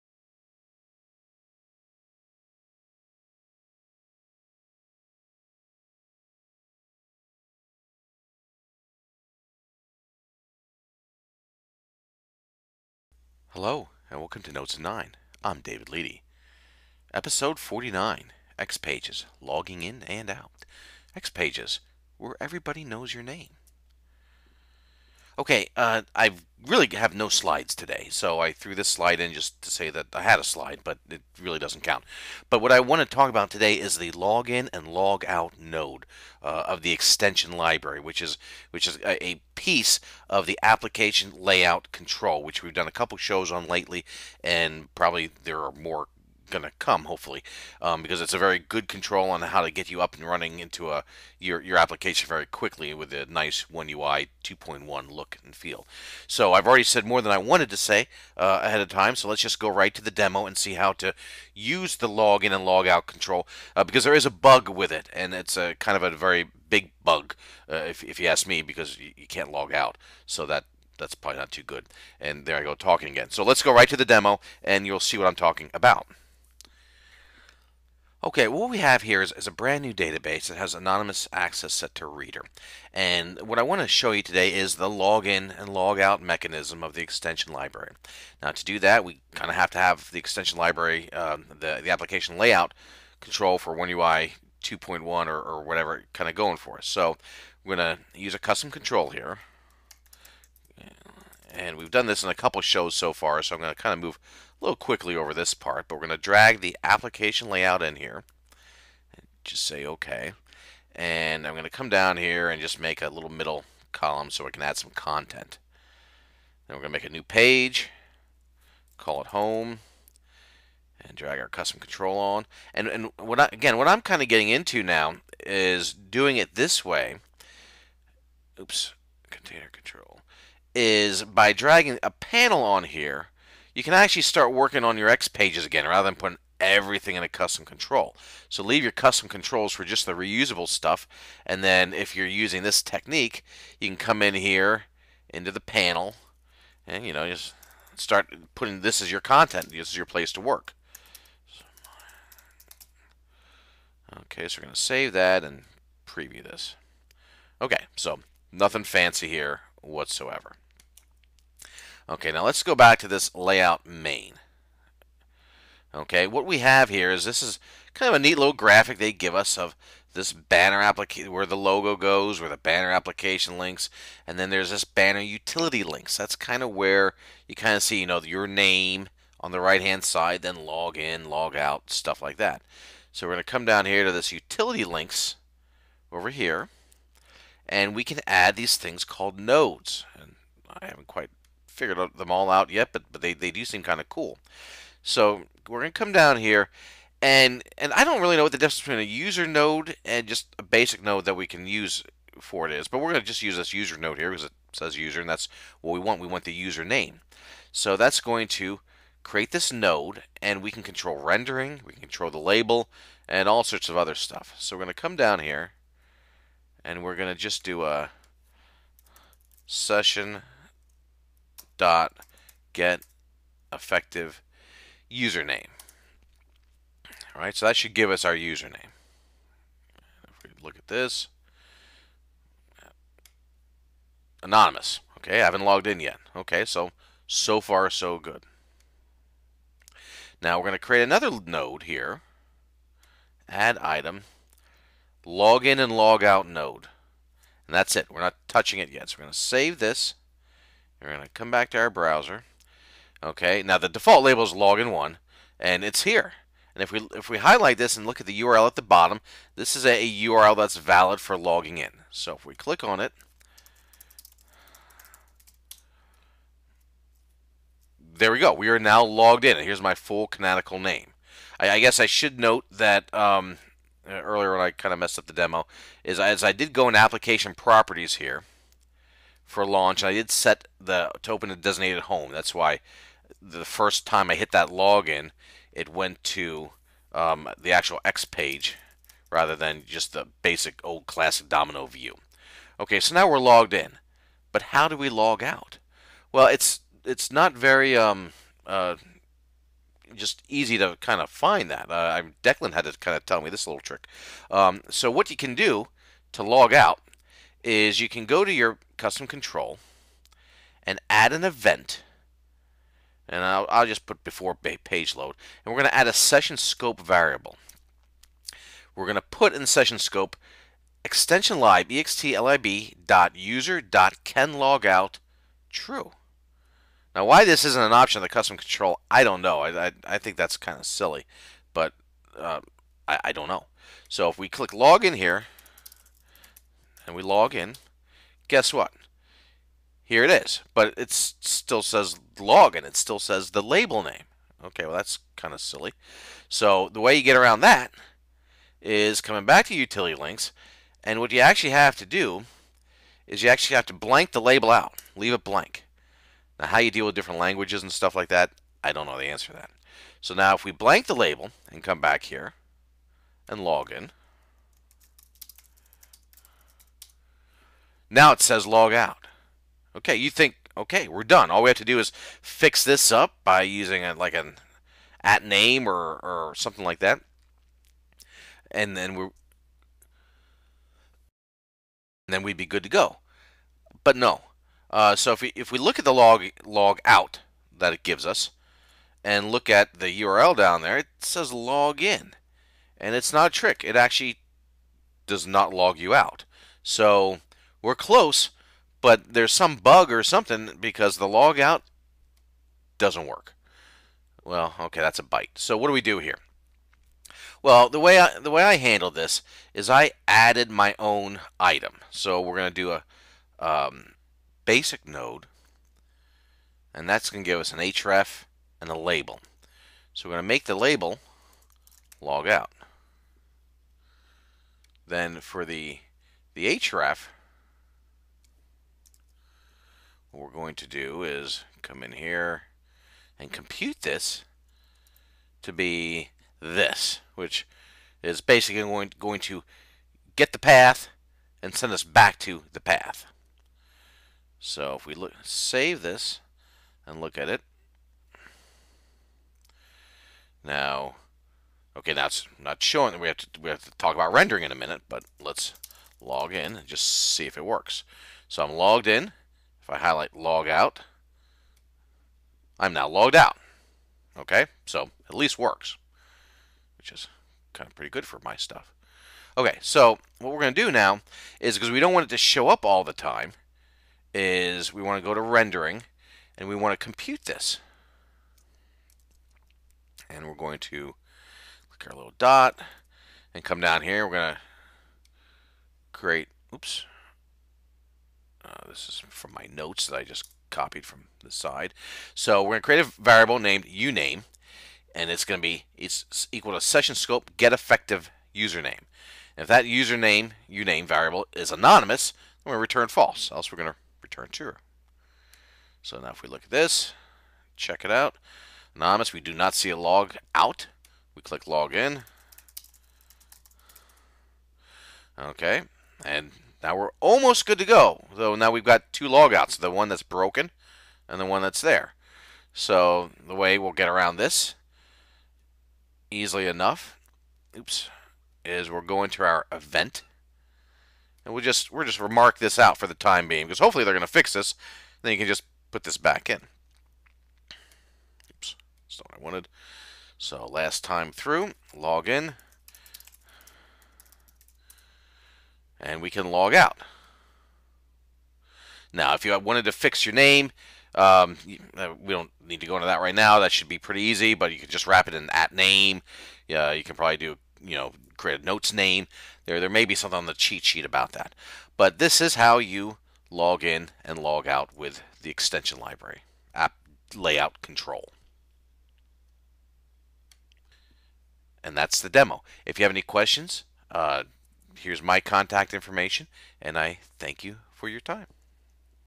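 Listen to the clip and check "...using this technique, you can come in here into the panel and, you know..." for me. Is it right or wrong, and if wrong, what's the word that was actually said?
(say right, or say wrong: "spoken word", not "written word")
right.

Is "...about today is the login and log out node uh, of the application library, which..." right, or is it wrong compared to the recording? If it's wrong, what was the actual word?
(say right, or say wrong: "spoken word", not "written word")
wrong: "extension", not "application".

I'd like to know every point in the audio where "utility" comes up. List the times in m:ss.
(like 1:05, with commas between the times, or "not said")
2:55, 3:04, 5:49.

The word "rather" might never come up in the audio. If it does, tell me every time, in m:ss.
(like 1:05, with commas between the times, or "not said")
2:15, 4:49.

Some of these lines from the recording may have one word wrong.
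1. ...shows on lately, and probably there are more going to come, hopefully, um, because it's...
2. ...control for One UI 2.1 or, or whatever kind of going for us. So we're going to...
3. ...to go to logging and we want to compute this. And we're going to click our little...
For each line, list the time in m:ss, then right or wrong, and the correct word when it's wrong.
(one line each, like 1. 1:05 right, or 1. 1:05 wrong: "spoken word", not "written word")
1. 0:43 right
2. 1:33 right
3. 7:55 wrong: "rendering", not "logging".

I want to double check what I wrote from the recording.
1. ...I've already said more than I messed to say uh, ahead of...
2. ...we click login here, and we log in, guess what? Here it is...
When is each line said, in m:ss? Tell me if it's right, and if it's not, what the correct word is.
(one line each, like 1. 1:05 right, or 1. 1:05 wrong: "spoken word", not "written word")
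1. 0:56 wrong: "wanted", not "messed"
2. 5:34 right.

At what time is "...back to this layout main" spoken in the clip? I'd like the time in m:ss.
2:42.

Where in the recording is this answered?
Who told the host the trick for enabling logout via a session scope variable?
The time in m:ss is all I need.
5:02.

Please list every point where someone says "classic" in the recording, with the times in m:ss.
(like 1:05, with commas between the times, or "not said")
4:51.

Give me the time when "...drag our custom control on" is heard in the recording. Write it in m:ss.
2:01.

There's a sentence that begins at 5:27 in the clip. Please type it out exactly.
Now, why this isn't an option of the custom control, I don't know.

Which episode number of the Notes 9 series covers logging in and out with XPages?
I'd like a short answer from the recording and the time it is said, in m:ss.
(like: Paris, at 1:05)
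49, at 0:17.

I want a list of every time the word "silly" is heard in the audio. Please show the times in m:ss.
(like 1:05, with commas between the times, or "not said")
5:30, 5:45.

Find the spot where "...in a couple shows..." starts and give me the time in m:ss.
1:42.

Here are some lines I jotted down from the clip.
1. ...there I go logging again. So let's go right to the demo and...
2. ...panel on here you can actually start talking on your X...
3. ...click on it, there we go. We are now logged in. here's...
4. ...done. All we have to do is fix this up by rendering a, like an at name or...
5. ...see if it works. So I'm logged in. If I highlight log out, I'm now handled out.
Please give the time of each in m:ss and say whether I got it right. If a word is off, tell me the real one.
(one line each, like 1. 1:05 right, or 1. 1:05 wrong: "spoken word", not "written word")
1. 1:12 wrong: "talking", not "logging"
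2. 2:12 wrong: "working", not "talking"
3. 4:22 right
4. 6:11 wrong: "using", not "rendering"
5. 7:37 wrong: "logged", not "handled".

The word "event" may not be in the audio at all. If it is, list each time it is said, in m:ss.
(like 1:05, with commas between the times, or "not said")
5:11, 8:49.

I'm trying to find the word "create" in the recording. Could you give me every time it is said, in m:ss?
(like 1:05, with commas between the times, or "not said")
3:29, 4:00, 8:06, 8:12, 9:18.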